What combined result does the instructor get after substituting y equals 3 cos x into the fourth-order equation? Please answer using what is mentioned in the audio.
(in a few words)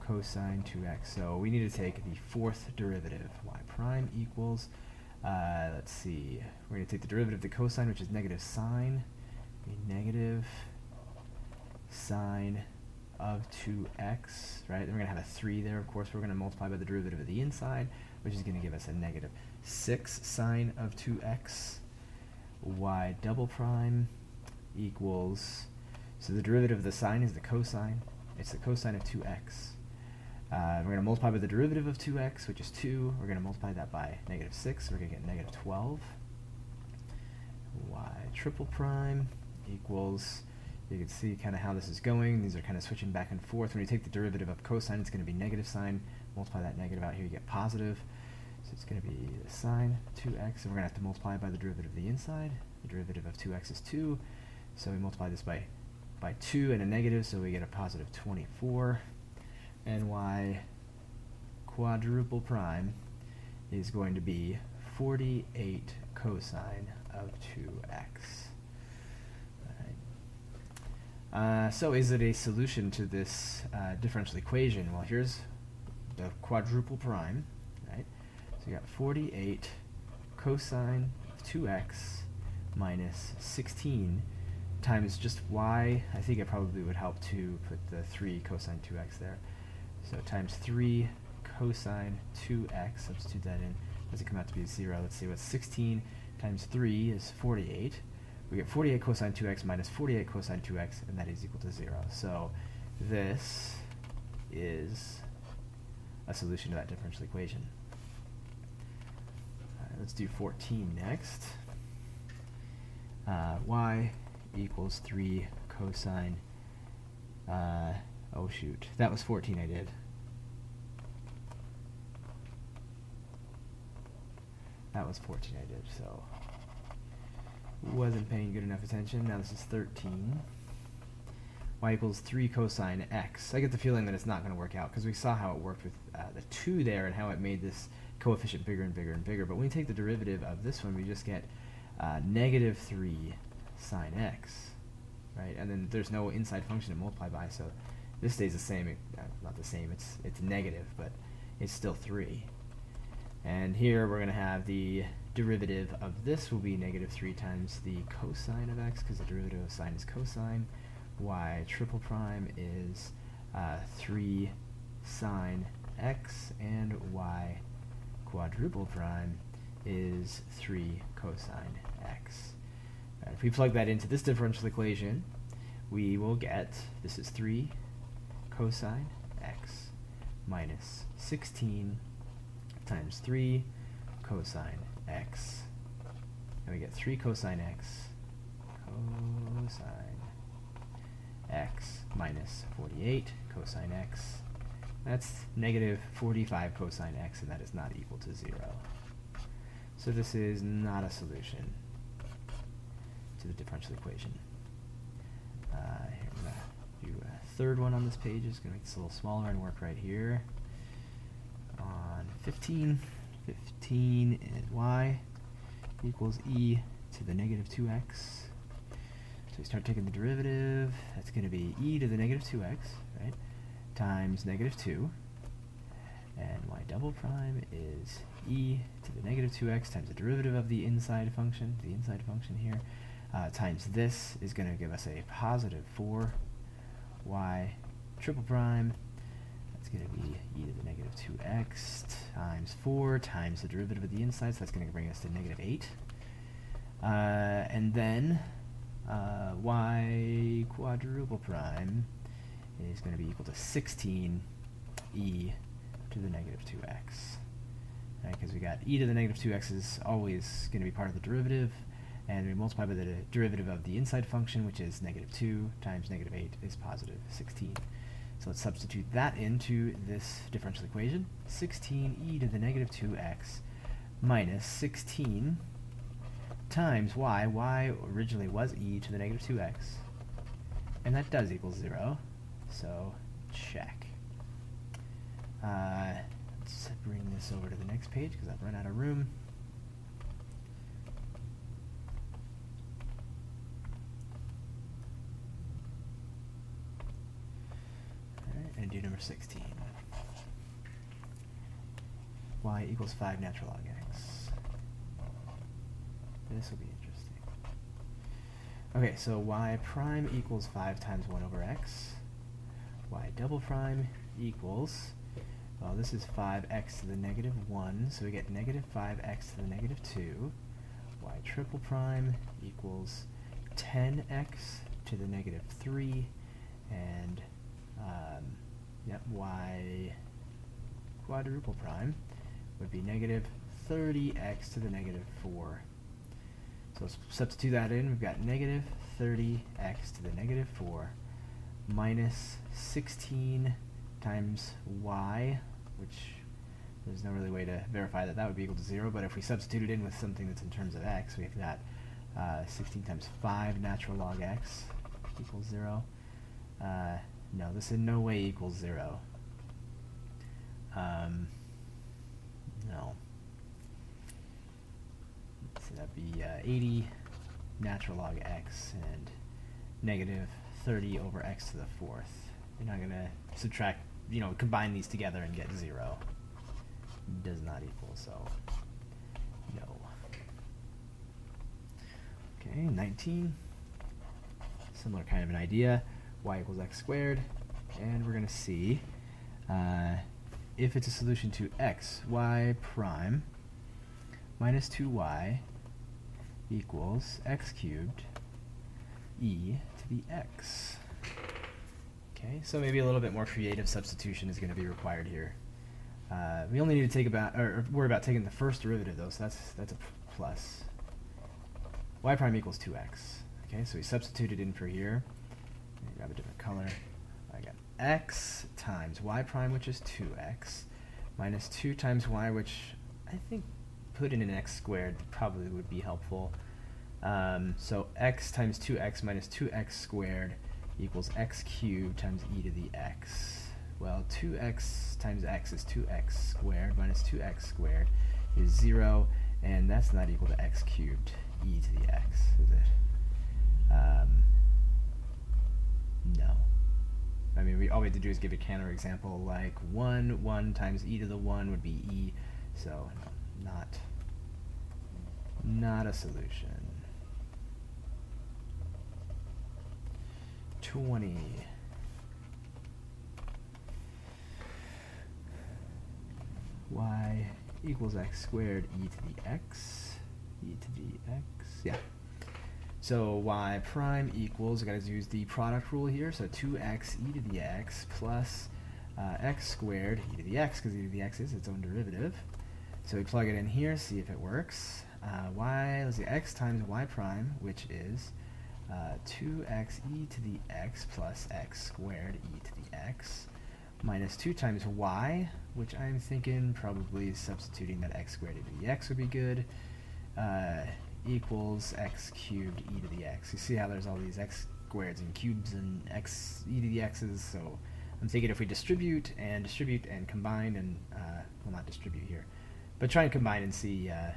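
-45 cos x.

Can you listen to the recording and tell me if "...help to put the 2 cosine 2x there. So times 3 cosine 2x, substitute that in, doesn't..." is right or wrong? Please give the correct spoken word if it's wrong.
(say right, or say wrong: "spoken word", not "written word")
wrong: "3", not "2".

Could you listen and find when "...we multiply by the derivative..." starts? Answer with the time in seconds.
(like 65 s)
262 s.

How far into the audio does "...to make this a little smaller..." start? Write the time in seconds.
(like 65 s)
208 s.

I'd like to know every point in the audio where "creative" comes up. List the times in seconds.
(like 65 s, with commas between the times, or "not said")
403 s.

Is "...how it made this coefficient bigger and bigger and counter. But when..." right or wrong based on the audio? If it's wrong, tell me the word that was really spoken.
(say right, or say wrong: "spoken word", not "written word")
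wrong: "bigger", not "counter".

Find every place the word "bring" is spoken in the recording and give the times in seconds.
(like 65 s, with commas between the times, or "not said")
244 s, 287 s.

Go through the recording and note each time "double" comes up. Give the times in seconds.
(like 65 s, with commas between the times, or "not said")
23 s, 226 s, 313 s.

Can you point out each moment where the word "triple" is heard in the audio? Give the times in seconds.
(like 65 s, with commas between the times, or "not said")
38 s, 161 s, 238 s, 321 s.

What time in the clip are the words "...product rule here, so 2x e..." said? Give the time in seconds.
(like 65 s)
475 s.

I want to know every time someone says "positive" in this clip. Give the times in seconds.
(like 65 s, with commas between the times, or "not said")
47 s, 57 s, 235 s, 266 s.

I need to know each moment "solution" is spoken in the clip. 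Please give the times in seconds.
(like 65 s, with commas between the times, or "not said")
72 s, 106 s, 201 s, 391 s, 456 s.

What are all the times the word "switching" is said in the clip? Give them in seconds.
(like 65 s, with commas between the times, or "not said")
42 s.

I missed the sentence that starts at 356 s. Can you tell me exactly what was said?
Uh, no, this in no way equals zero.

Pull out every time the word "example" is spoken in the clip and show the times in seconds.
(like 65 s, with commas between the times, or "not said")
448 s.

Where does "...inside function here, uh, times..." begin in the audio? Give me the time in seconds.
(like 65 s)
231 s.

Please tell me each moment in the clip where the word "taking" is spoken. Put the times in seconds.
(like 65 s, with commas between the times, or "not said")
219 s, 408 s.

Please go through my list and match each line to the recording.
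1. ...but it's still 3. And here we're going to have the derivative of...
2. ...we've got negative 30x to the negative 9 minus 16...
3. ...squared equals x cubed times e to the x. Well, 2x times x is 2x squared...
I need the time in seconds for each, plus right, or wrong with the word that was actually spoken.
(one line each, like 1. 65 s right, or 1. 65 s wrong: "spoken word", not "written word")
1. 150 s right
2. 338 s wrong: "4", not "9"
3. 429 s right.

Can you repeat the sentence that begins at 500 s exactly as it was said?
Uh, equals x cubed e to the x.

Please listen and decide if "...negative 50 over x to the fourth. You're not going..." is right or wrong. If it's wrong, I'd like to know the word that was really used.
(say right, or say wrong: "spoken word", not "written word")
wrong: "30", not "50".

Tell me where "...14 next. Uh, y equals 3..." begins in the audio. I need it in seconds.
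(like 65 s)
110 s.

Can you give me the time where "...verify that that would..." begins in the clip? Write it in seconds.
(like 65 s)
347 s.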